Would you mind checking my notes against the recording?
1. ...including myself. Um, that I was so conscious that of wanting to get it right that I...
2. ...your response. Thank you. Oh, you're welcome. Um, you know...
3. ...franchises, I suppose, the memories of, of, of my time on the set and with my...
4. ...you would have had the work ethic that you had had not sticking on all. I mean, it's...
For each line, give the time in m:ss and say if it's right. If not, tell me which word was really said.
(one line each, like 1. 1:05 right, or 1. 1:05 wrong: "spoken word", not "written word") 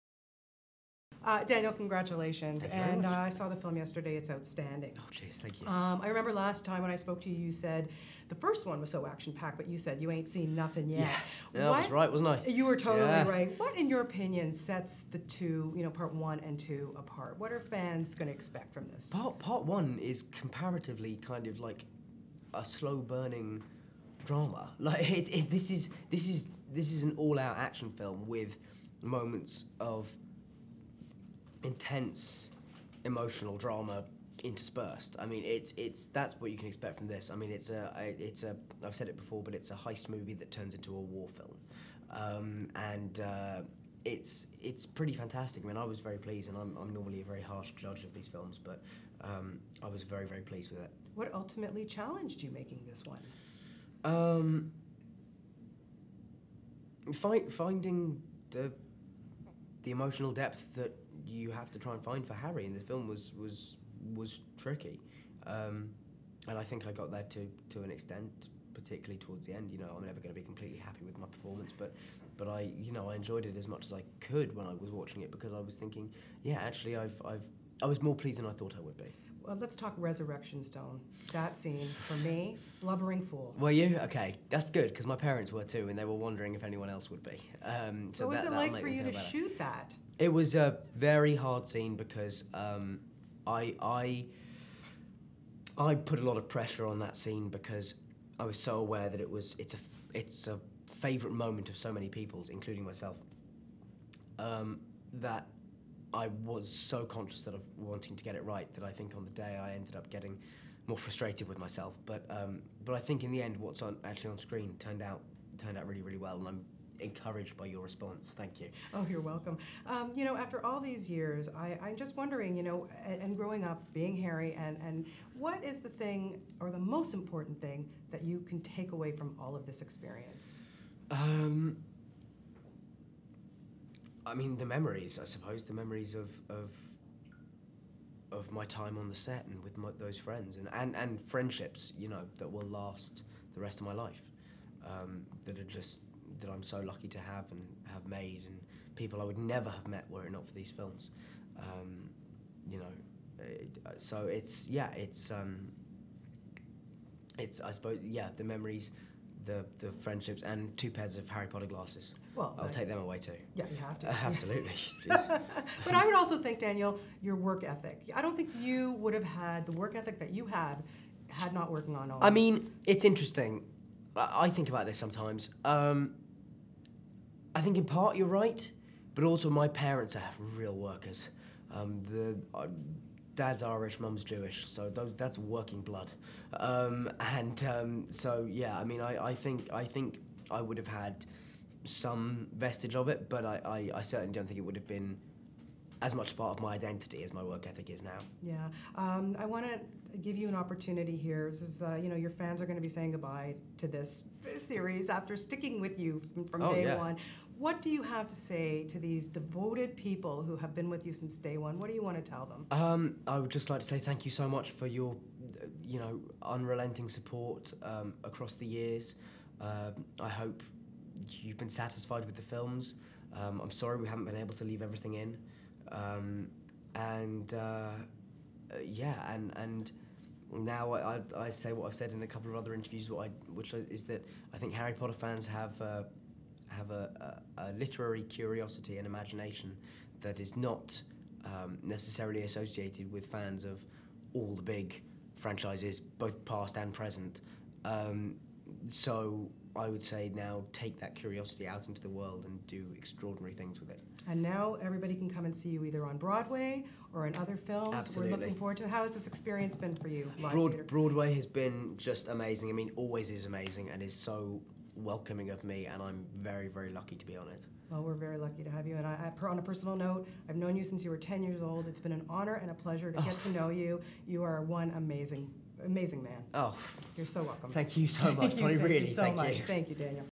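1. 1:42 right
2. 1:57 right
3. 2:14 wrong: "memories", not "franchises"
4. 2:48 wrong: "working", not "sticking".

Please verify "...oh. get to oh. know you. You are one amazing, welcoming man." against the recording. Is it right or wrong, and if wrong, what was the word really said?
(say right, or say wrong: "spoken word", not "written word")
wrong: "amazing", not "welcoming".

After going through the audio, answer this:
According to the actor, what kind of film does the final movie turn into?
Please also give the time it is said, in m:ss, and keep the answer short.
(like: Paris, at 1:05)
a war film, at 0:40.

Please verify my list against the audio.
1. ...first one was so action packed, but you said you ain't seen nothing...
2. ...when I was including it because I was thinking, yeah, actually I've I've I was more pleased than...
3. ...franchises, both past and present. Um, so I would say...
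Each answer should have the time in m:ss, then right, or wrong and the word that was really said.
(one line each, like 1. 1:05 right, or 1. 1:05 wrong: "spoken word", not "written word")
1. 0:08 right
2. 1:14 wrong: "watching", not "including"
3. 4:05 right.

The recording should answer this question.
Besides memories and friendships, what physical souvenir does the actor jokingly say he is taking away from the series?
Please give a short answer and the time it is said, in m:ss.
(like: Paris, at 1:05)
two pairs of Harry Potter glasses, at 2:40.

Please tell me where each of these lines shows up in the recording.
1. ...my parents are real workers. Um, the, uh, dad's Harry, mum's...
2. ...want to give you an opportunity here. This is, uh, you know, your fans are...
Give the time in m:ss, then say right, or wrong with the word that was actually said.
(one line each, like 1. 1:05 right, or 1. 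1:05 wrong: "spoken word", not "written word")
1. 2:59 wrong: "Irish", not "Harry"
2. 3:19 right.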